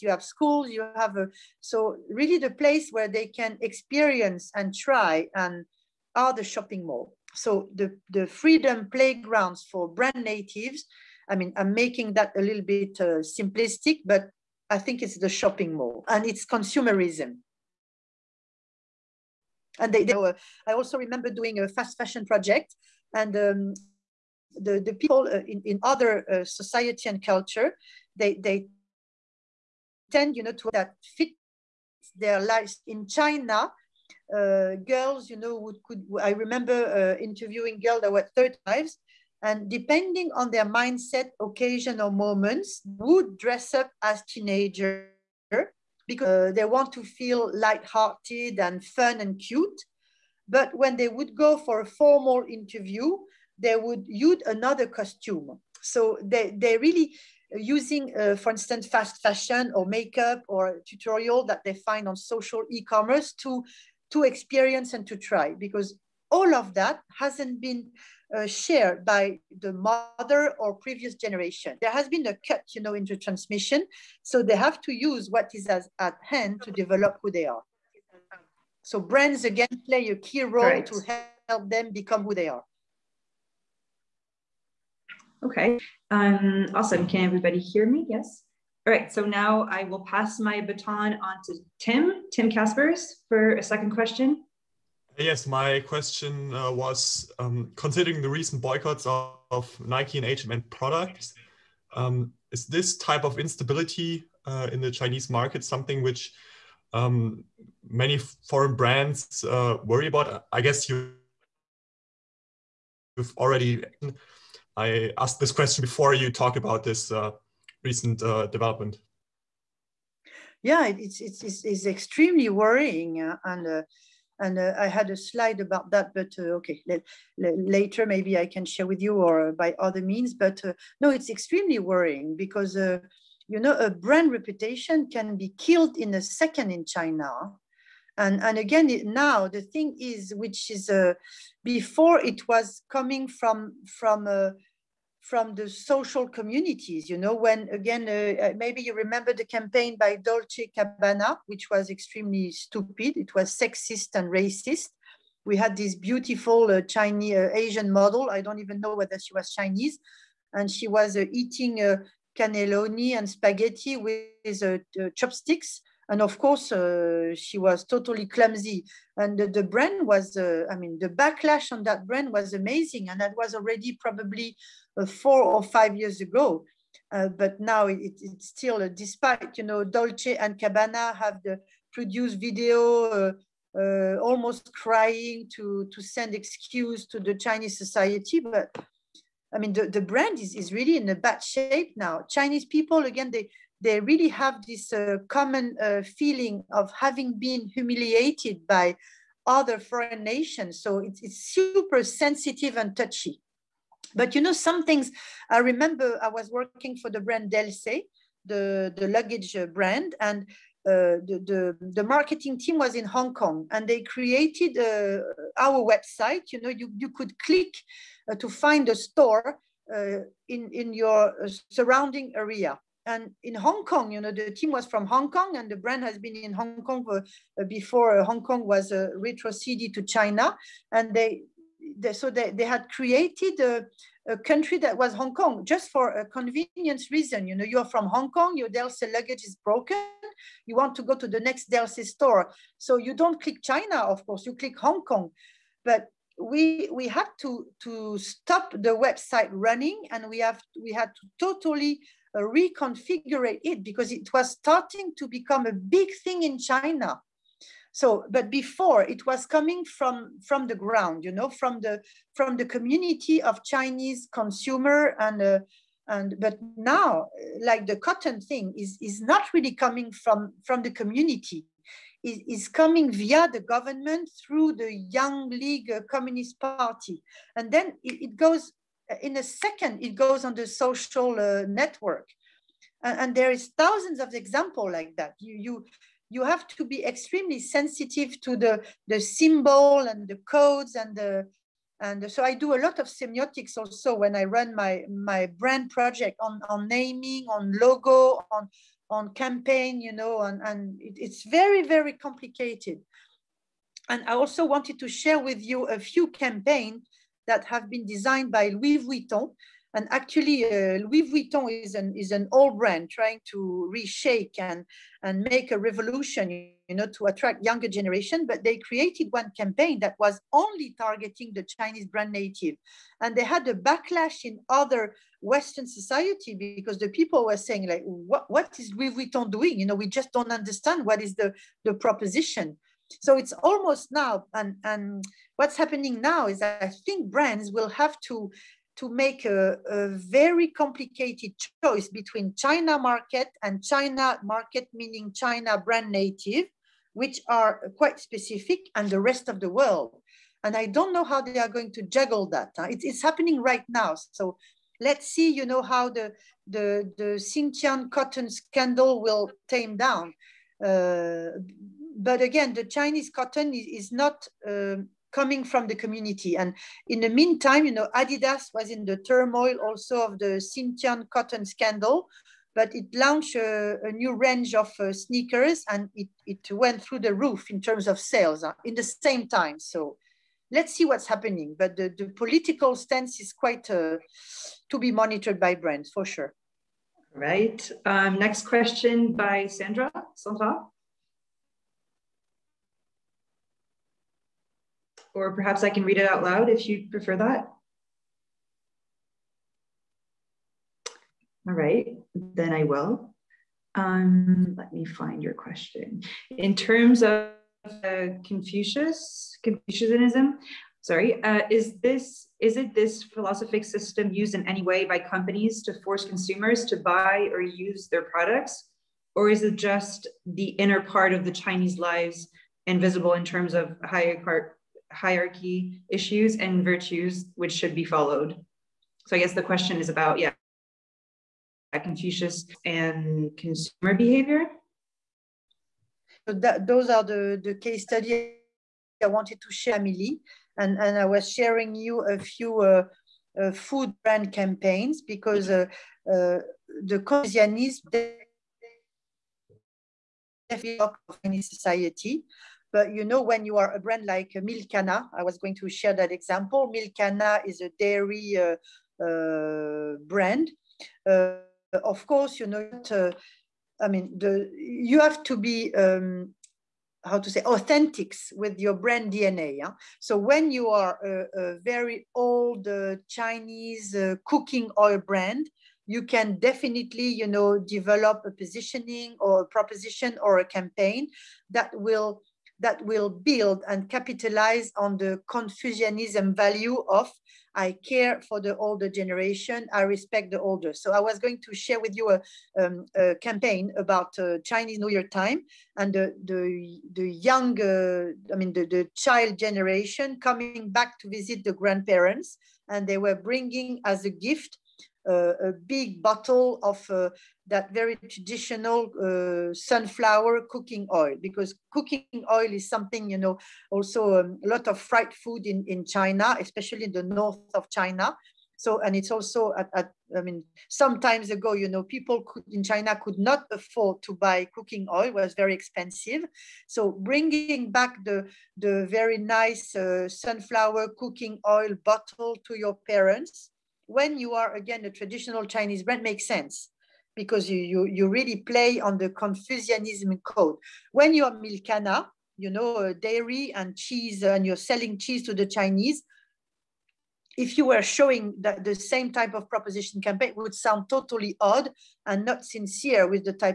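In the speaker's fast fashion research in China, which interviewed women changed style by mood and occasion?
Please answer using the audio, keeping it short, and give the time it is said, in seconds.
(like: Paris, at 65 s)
third wives, at 38 s.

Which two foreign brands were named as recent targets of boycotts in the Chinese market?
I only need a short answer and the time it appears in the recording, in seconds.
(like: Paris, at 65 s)
Nike and H&M, at 99 s.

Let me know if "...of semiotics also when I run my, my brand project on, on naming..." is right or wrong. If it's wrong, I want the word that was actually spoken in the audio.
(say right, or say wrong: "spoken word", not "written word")
right.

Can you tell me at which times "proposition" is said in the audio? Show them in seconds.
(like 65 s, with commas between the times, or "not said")
331 s, 479 s, 549 s.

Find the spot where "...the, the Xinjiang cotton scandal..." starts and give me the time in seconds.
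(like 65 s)
356 s.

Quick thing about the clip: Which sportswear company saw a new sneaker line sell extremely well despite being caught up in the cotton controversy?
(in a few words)
Adidas.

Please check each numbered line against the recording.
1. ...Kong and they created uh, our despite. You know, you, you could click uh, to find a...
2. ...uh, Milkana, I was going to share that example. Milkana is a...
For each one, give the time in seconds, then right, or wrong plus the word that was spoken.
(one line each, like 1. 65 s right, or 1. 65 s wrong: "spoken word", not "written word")
1. 213 s wrong: "website", not "despite"
2. 454 s right.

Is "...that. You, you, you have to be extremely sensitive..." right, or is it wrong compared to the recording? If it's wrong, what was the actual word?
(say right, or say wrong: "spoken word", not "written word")
right.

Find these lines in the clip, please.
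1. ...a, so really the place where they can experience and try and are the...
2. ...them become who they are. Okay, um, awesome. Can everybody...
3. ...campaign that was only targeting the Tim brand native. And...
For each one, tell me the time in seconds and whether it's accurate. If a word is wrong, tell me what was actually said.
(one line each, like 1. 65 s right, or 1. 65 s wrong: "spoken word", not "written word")
1. 1 s right
2. 81 s right
3. 319 s wrong: "Chinese", not "Tim".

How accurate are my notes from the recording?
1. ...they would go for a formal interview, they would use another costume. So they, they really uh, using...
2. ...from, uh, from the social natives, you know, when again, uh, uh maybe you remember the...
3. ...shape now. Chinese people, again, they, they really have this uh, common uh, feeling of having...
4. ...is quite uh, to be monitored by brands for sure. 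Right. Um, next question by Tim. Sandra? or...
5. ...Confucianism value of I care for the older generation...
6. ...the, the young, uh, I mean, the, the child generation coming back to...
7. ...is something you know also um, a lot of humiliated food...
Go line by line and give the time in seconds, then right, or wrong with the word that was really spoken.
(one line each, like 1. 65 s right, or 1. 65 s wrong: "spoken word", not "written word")
1. 50 s right
2. 143 s wrong: "communities", not "natives"
3. 191 s right
4. 383 s wrong: "Sandra", not "Tim"
5. 485 s right
6. 496 s right
7. 512 s wrong: "fried", not "humiliated".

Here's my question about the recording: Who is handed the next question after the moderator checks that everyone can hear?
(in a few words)
Tim Caspers.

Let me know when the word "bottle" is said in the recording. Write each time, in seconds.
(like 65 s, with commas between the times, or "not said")
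506 s, 532 s.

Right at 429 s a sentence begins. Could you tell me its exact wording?
So I guess the question is about, yeah, Confucius and consumer behavior.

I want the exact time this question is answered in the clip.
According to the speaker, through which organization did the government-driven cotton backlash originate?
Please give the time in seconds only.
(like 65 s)
274 s.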